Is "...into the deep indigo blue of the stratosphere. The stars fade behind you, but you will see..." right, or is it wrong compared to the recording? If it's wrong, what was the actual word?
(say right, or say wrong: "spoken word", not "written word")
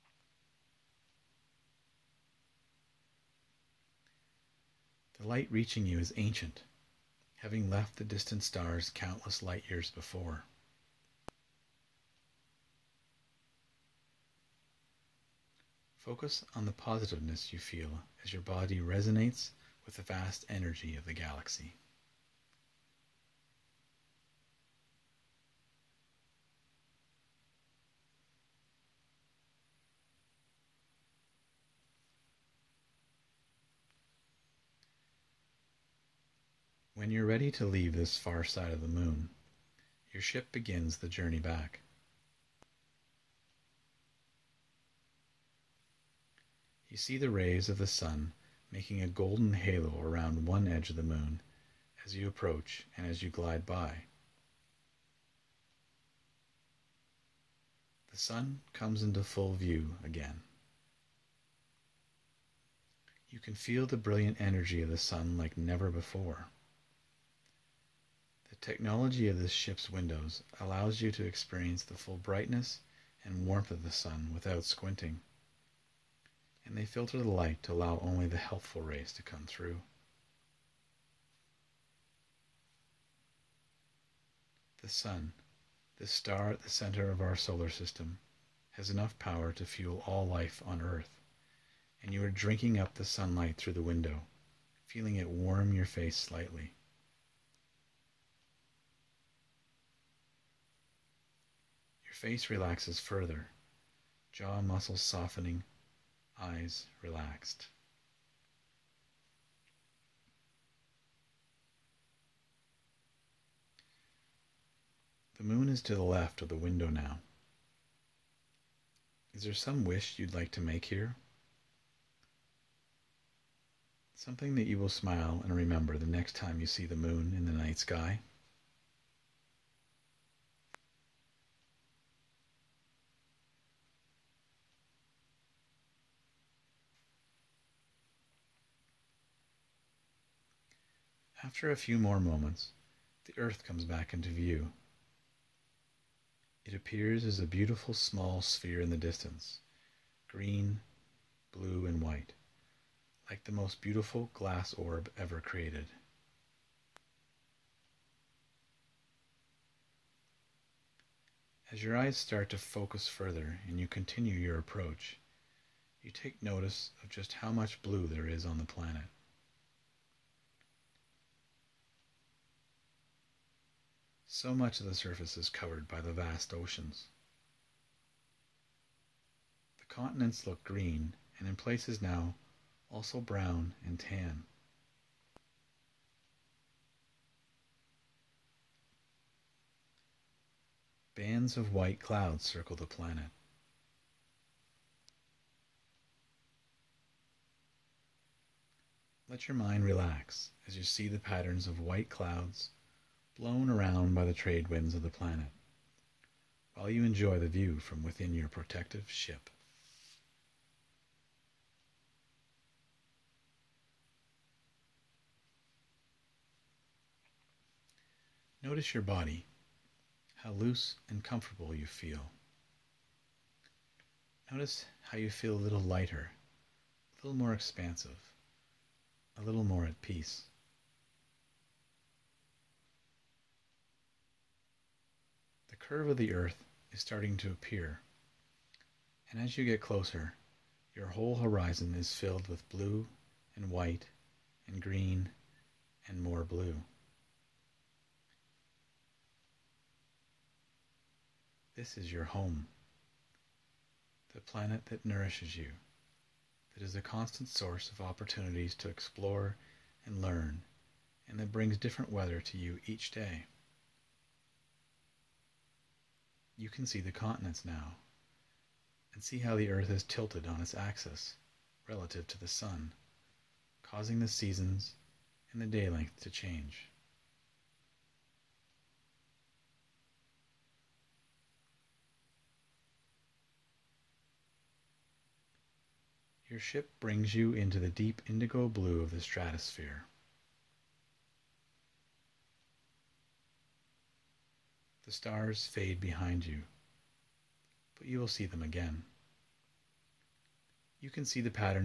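right.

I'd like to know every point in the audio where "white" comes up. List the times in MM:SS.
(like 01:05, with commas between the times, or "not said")
02:31, 03:11, 03:21, 04:03.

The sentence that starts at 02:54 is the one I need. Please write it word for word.
So much of the surface is covered by the vast oceans.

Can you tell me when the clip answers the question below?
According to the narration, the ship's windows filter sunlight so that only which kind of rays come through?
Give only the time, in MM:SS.
01:18.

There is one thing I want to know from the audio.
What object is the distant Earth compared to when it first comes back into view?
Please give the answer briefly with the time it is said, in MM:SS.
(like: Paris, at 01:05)
Glass orb, at 02:34.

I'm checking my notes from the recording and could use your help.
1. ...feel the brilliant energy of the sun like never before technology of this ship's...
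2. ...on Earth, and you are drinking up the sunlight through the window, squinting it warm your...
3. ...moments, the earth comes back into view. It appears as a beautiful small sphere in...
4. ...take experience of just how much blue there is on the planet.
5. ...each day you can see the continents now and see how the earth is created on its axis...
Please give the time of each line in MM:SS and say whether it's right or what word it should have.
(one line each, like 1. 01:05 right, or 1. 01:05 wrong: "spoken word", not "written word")
1. 01:03 right
2. 01:30 wrong: "feeling", not "squinting"
3. 02:22 right
4. 02:46 wrong: "notice", not "experience"
5. 04:22 wrong: "tilted", not "created".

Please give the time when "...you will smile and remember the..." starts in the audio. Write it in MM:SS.
02:04.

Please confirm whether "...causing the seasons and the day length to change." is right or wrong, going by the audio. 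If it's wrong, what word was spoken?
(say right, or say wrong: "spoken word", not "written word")
right.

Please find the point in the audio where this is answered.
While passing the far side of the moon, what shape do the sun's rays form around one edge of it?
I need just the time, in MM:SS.
00:49.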